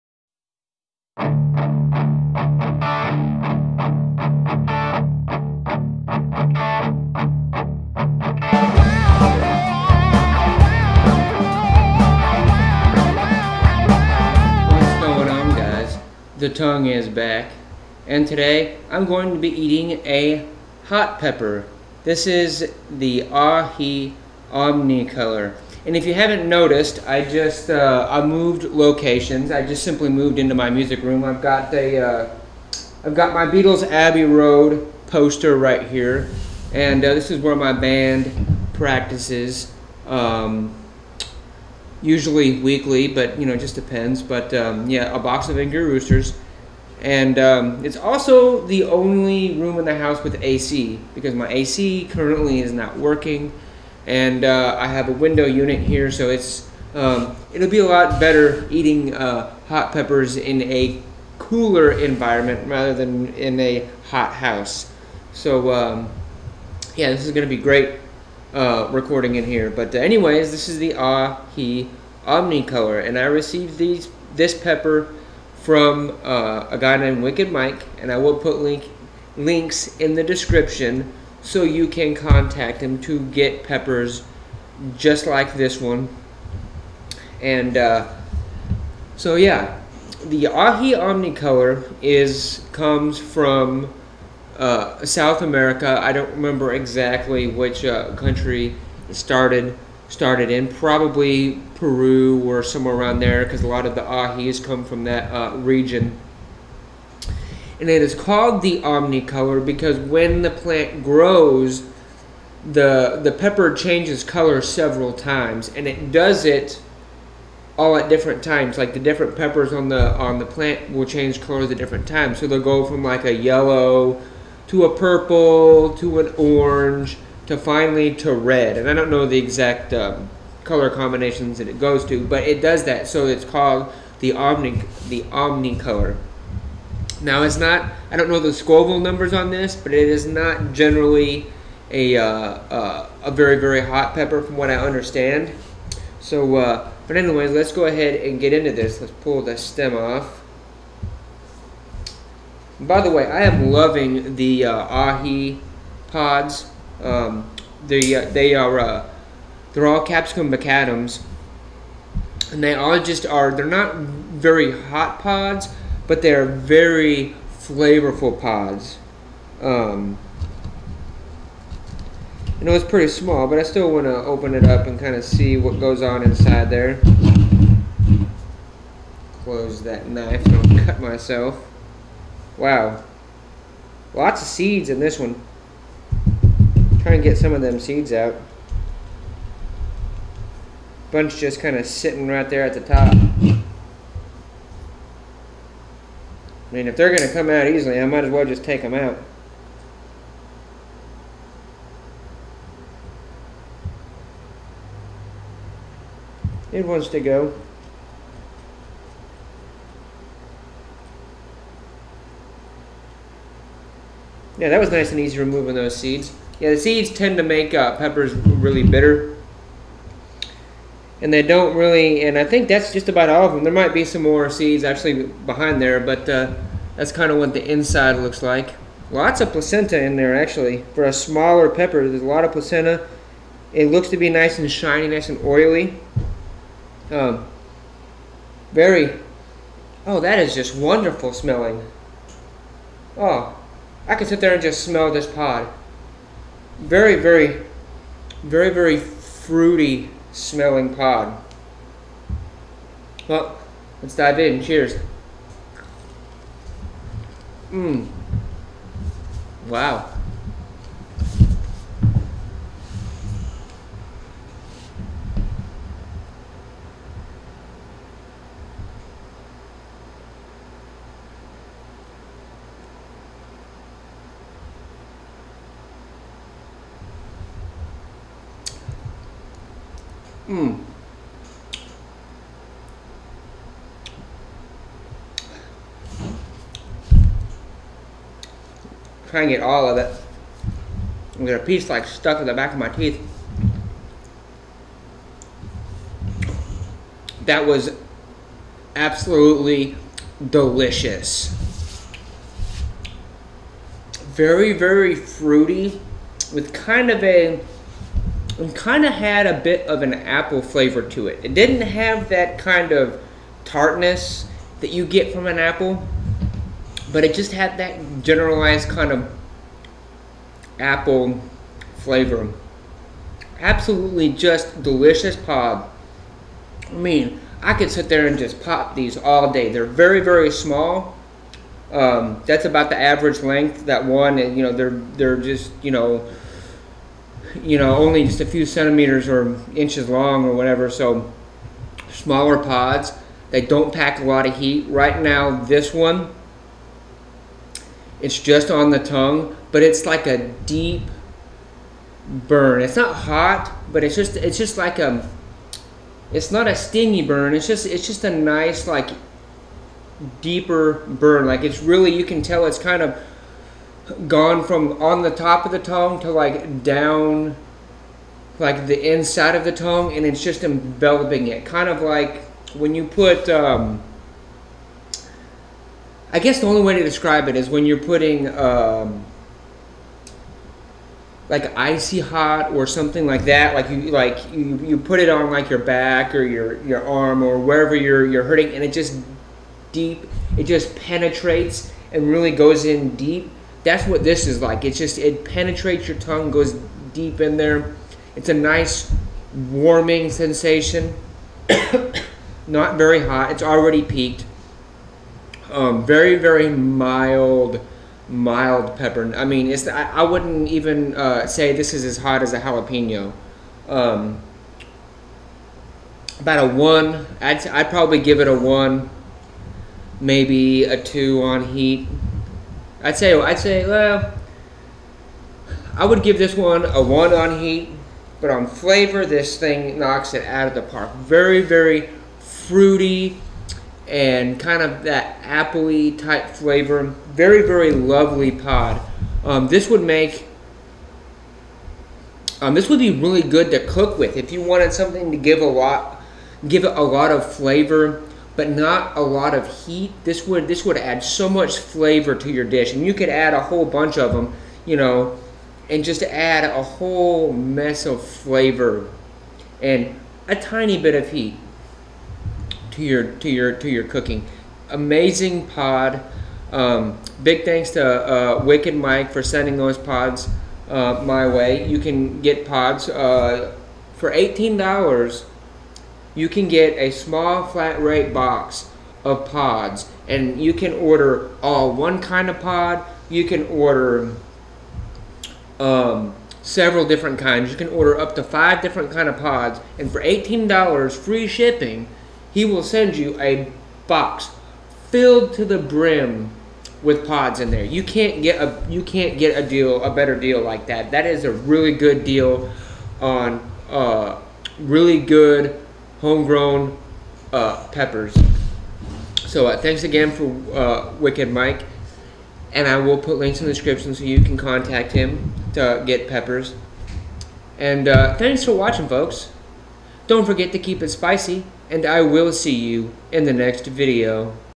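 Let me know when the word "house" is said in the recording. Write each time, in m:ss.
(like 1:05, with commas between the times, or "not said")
0:49, 1:04.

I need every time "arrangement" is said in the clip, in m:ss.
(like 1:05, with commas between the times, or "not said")
not said.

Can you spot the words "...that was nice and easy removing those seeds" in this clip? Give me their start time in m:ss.
3:34.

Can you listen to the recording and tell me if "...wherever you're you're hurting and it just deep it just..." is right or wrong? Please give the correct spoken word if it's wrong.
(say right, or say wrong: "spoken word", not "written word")
right.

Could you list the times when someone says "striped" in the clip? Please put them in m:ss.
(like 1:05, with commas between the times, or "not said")
not said.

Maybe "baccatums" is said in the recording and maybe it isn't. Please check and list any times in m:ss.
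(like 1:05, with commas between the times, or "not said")
2:40.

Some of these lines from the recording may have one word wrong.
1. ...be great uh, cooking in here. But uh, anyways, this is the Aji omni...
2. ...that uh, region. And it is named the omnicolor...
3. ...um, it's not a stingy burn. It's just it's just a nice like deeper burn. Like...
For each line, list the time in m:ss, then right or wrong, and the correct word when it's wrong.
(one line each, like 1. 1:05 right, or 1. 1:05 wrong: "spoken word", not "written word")
1. 1:07 wrong: "recording", not "cooking"
2. 1:45 wrong: "called", not "named"
3. 5:55 right.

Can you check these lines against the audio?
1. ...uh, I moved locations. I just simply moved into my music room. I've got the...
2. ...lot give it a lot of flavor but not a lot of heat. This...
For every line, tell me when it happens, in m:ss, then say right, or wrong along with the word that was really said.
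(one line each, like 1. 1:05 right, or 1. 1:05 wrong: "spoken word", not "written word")
1. 0:27 right
2. 7:25 right.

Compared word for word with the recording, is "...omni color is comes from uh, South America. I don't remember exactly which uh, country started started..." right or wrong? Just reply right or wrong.
right.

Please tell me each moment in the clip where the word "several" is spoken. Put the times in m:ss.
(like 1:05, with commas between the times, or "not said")
1:54, 8:06.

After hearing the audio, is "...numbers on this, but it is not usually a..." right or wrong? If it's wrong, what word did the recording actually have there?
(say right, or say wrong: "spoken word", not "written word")
wrong: "generally", not "usually".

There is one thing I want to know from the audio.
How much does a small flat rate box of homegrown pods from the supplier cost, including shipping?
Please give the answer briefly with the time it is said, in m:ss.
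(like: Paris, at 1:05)
$18, at 7:54.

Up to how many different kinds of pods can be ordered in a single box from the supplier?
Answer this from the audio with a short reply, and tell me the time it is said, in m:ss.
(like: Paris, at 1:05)
5, at 8:08.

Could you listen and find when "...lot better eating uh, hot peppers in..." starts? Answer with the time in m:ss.
0:57.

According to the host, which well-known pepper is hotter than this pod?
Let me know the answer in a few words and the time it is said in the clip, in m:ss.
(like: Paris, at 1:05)
Jalapeno, at 6:52.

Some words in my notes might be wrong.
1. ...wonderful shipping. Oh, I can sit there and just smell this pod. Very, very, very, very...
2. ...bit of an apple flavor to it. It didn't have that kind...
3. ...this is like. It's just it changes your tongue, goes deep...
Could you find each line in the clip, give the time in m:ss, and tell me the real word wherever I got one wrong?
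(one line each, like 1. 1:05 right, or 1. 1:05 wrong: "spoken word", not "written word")
1. 4:00 wrong: "smelling", not "shipping"
2. 5:09 right
3. 6:34 wrong: "penetrates", not "changes".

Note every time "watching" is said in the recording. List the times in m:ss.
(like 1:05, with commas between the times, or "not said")
8:38.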